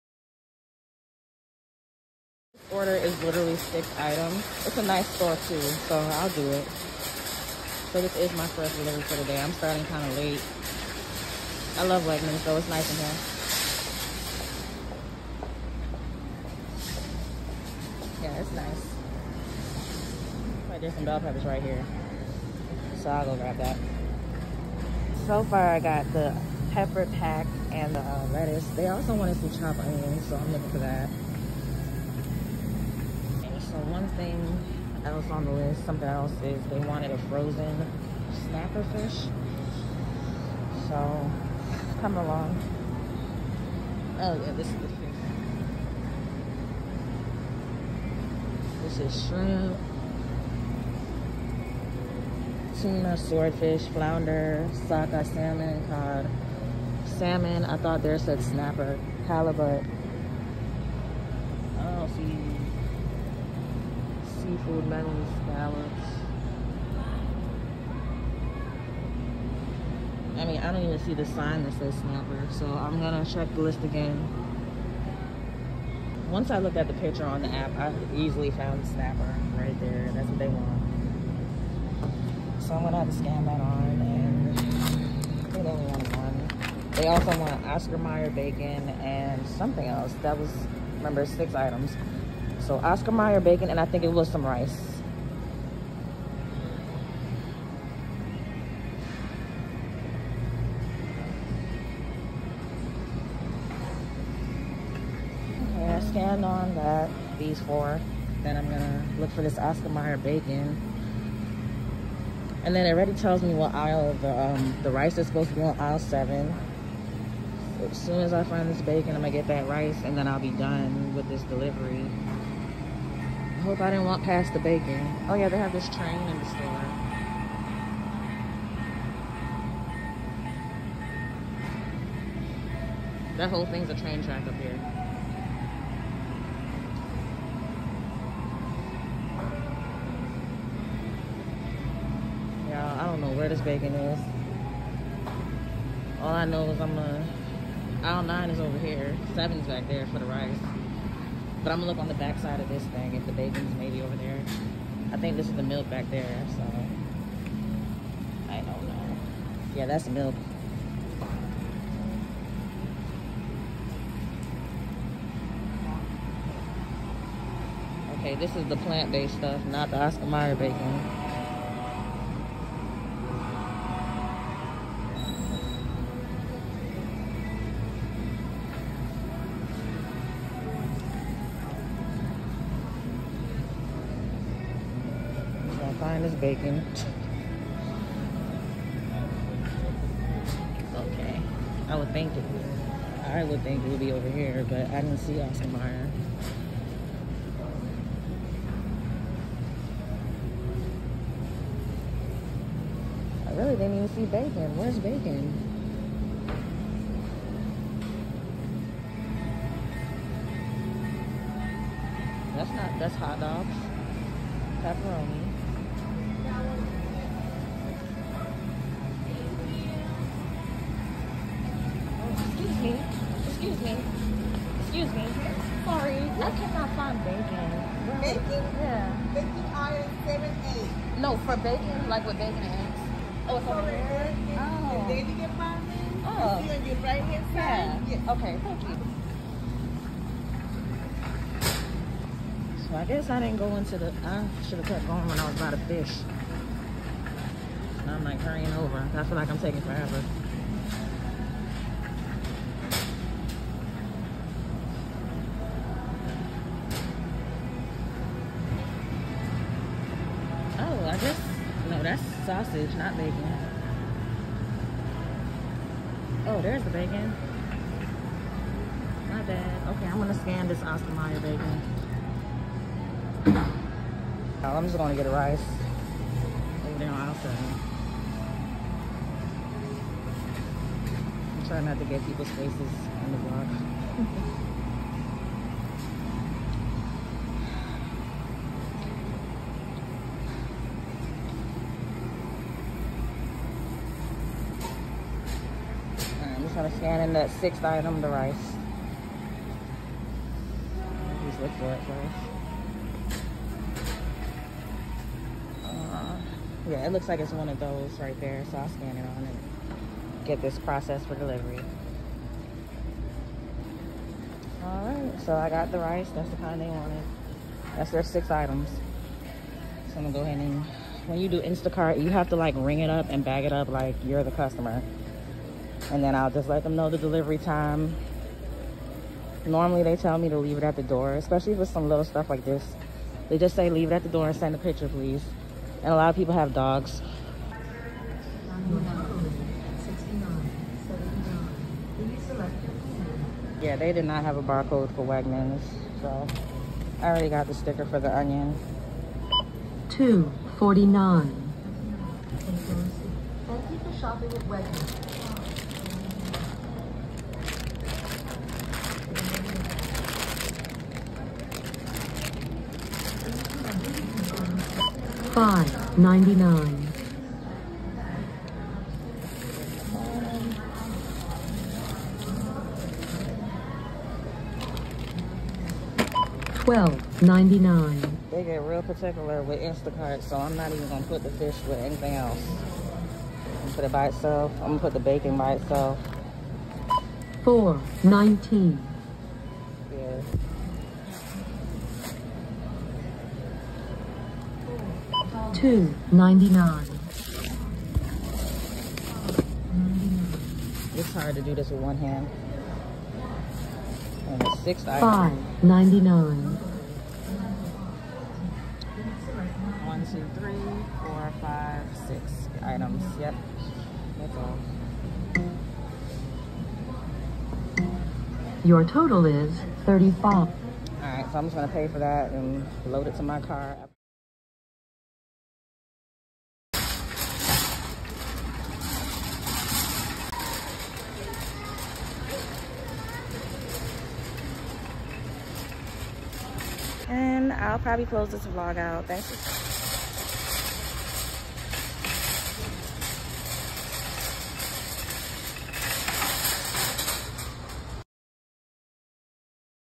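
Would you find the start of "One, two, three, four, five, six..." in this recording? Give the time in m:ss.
6:50.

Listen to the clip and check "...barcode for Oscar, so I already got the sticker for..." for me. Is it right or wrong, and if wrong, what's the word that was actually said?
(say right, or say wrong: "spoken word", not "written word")
wrong: "Wegmans", not "Oscar".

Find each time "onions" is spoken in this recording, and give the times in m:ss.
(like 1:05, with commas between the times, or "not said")
0:29, 5:48.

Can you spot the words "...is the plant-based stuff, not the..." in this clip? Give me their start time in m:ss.
2:48.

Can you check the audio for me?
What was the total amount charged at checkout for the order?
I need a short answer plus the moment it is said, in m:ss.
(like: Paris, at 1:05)
35, at 7:00.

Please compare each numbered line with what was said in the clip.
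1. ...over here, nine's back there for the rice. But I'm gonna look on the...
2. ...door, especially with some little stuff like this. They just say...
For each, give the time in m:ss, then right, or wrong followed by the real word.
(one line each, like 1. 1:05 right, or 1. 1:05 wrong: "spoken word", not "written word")
1. 2:28 wrong: "seven", not "nine"
2. 5:31 right.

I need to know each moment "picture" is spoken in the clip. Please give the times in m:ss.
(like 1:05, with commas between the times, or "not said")
1:16, 5:34.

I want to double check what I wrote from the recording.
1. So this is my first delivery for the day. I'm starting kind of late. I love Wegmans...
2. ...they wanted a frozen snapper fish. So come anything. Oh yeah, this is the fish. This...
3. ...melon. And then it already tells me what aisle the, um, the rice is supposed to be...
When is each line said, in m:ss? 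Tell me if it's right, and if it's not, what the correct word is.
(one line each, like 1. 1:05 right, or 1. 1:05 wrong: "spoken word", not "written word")
1. 0:07 right
2. 0:36 wrong: "along", not "anything"
3. 1:50 wrong: "bacon", not "melon".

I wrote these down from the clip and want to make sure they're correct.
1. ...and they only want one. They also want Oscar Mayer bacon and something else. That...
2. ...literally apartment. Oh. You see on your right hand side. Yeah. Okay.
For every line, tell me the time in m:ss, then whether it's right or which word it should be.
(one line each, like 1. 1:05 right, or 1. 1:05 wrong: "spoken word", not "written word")
1. 1:24 right
2. 3:55 wrong: "daily", not "literally".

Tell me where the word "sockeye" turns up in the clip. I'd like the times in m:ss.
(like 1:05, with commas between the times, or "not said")
0:54.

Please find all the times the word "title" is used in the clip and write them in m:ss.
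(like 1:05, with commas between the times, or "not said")
not said.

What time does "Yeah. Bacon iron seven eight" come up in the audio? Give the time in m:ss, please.
3:48.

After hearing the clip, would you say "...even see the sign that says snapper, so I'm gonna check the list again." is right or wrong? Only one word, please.
right.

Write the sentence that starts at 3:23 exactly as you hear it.
I really didn't even see bacon.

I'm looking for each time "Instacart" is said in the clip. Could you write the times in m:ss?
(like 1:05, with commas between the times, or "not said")
5:21, 6:19.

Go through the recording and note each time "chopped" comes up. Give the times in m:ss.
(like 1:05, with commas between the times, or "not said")
0:29.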